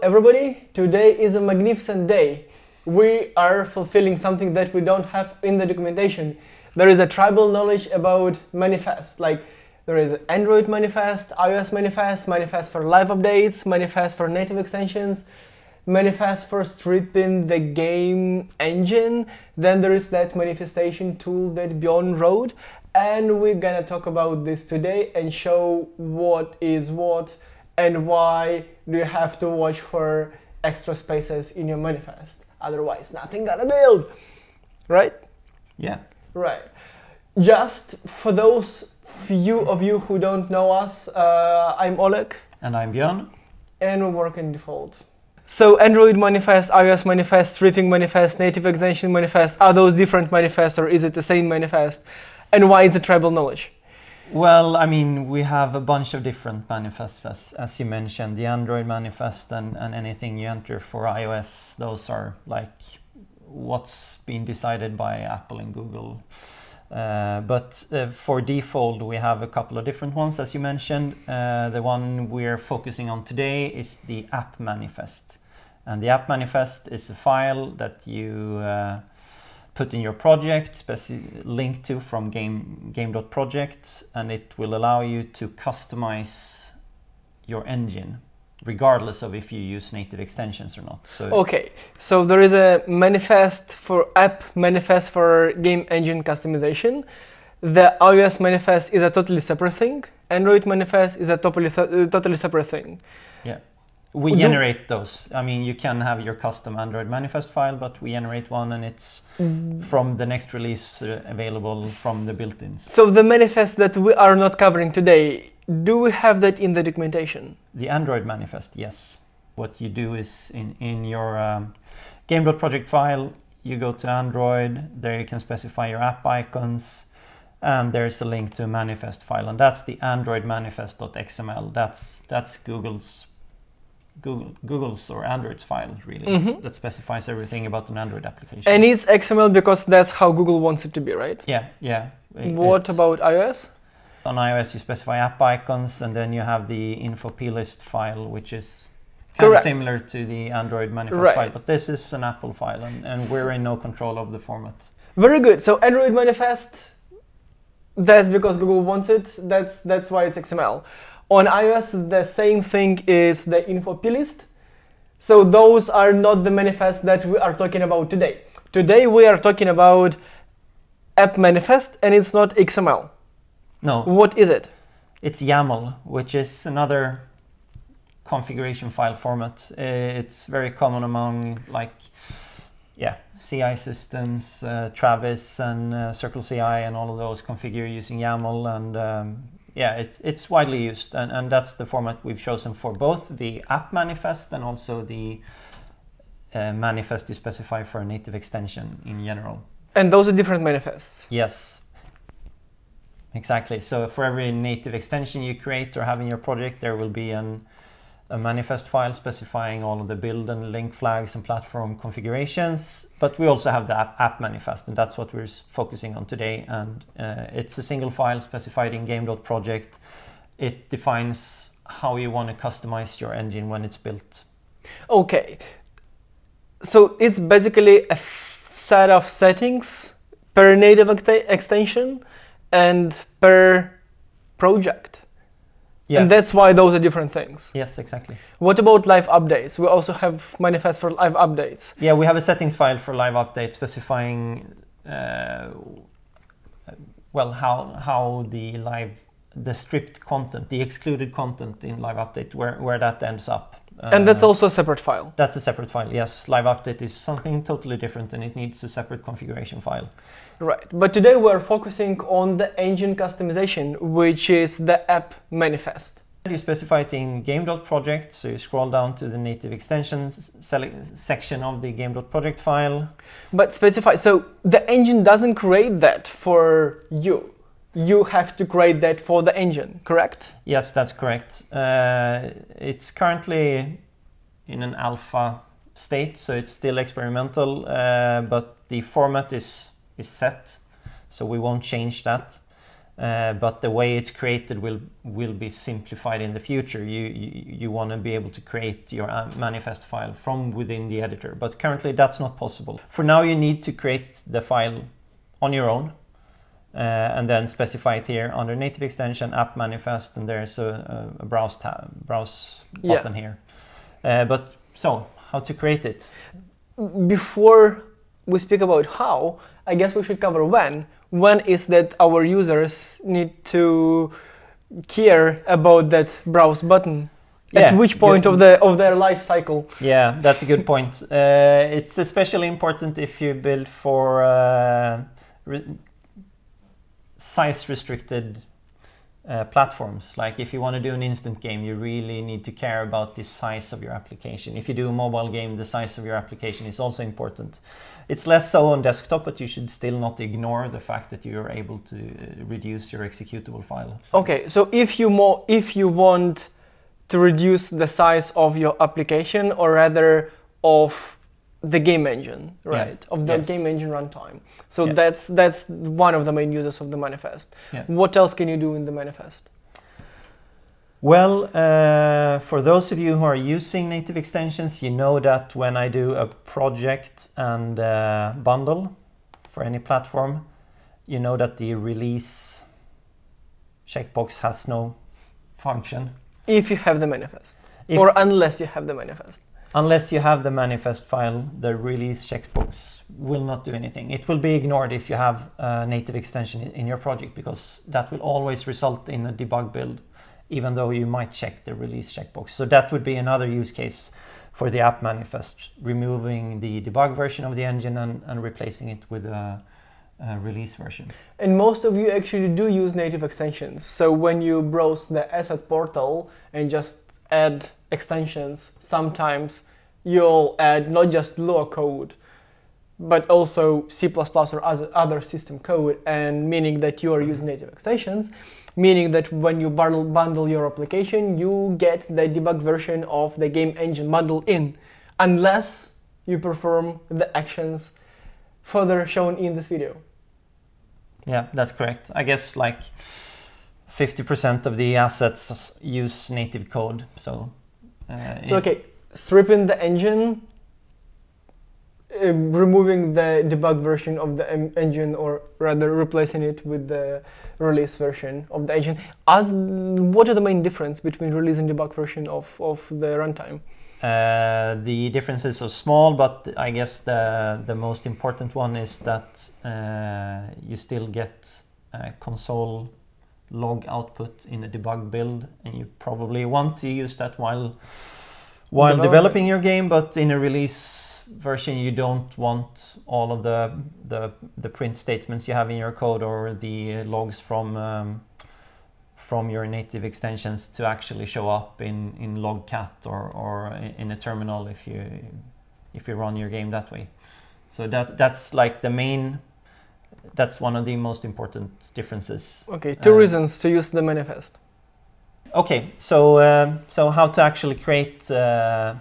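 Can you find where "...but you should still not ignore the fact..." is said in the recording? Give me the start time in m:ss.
5:49.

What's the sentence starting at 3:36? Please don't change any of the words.
And uh, it's a single file specified in game.project.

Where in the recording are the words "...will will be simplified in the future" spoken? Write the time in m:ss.
4:54.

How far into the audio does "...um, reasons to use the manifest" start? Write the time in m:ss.
8:23.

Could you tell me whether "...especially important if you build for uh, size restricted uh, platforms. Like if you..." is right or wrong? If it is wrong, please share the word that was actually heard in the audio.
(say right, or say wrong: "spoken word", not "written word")
right.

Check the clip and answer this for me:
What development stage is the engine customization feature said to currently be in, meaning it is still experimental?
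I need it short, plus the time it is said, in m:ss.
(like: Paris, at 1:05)
alpha, at 4:44.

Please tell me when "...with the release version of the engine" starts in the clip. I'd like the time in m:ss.
7:36.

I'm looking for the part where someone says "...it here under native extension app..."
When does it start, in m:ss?
5:08.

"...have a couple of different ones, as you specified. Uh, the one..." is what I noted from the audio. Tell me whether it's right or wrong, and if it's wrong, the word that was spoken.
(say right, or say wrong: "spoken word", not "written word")
wrong: "mentioned", not "specified".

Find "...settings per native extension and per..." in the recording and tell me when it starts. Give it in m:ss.
3:49.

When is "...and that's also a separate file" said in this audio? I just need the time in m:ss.
4:13.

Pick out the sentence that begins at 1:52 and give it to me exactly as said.
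So the manifest that we are not covering today, do we have that in the documentation?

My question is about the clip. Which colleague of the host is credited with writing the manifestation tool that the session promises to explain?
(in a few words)
Bjorn.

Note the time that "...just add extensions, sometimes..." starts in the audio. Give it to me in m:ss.
6:56.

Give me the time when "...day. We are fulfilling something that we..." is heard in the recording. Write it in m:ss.
0:02.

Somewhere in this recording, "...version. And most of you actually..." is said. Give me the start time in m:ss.
6:50.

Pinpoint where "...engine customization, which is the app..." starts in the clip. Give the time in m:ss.
4:22.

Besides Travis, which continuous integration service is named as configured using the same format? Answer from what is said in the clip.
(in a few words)
CircleCI.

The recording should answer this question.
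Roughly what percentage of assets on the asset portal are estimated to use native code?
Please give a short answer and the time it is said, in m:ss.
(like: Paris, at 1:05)
50%, at 7:24.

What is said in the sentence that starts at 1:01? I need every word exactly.
Those are like what's been decided by Apple and Google.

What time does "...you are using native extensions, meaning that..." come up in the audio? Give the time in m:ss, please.
7:07.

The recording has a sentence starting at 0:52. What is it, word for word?
And why is it tribal knowledge?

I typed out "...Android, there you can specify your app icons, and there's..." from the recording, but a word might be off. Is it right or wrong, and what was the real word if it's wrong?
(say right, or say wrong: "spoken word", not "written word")
right.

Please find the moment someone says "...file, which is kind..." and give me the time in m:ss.
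2:27.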